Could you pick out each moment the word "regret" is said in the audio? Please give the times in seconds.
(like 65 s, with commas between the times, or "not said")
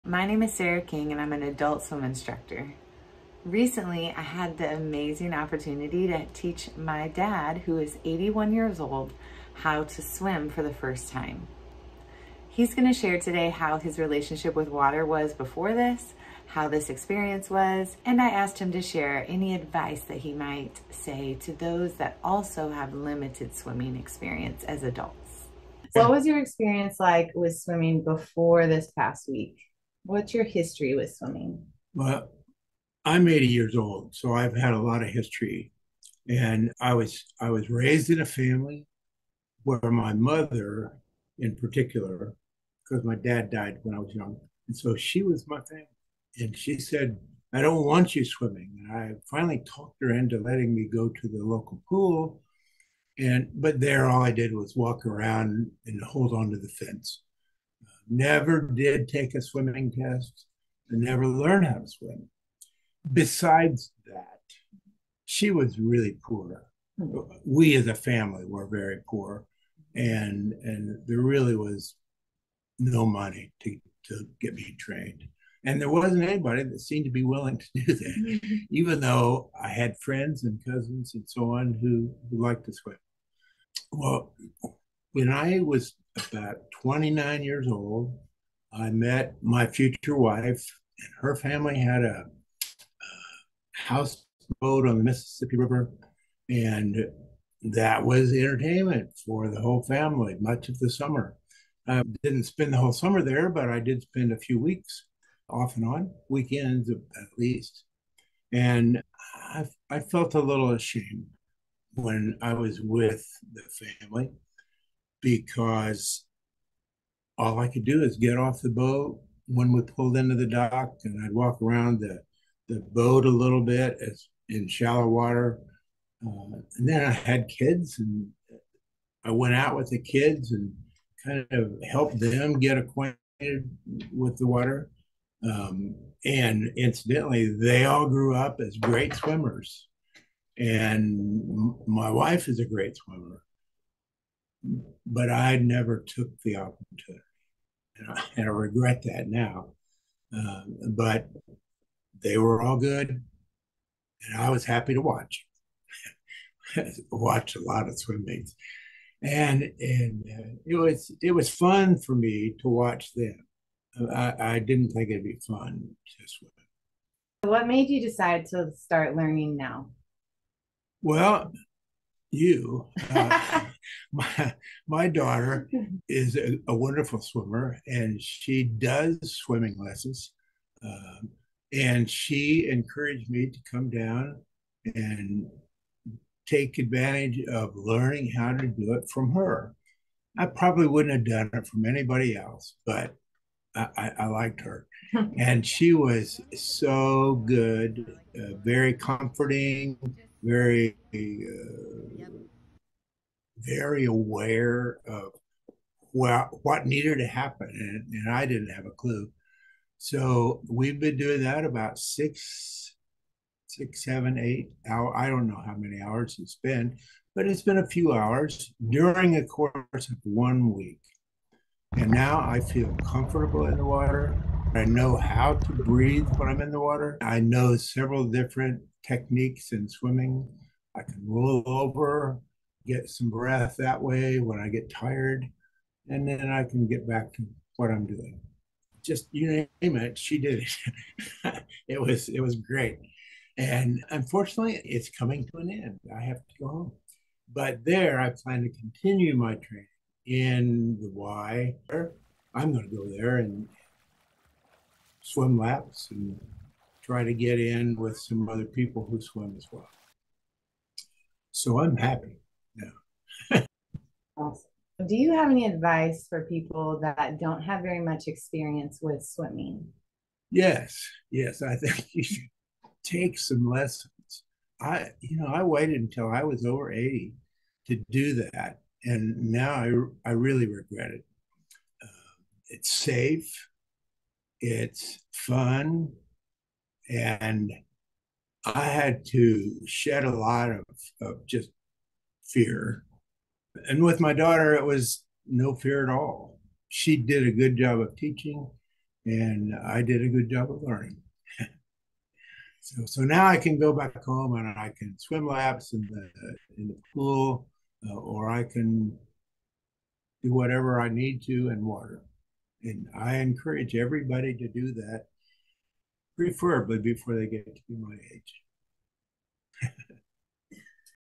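148 s, 280 s.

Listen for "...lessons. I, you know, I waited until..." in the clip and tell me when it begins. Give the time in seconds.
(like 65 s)
273 s.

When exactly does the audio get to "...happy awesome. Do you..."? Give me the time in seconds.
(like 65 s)
261 s.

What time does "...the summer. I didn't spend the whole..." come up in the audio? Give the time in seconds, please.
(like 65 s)
100 s.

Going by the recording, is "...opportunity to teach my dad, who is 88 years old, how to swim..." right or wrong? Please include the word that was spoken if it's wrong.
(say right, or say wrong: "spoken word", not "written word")
wrong: "81", not "88".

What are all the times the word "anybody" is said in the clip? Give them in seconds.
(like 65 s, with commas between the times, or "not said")
76 s, 191 s.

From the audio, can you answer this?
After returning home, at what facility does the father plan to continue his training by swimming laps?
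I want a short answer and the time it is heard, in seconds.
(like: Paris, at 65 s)
The Y, at 251 s.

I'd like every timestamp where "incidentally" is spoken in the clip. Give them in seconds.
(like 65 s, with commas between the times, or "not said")
136 s.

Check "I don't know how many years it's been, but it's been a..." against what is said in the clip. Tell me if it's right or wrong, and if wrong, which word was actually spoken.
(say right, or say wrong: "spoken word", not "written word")
wrong: "hours", not "years".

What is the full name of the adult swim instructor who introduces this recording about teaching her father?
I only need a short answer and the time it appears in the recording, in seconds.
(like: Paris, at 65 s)
Sarah King, at 0 s.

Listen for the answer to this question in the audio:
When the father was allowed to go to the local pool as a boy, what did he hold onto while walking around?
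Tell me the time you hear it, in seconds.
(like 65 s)
56 s.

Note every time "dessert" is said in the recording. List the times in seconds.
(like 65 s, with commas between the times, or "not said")
not said.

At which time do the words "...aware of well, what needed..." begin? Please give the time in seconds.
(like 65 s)
204 s.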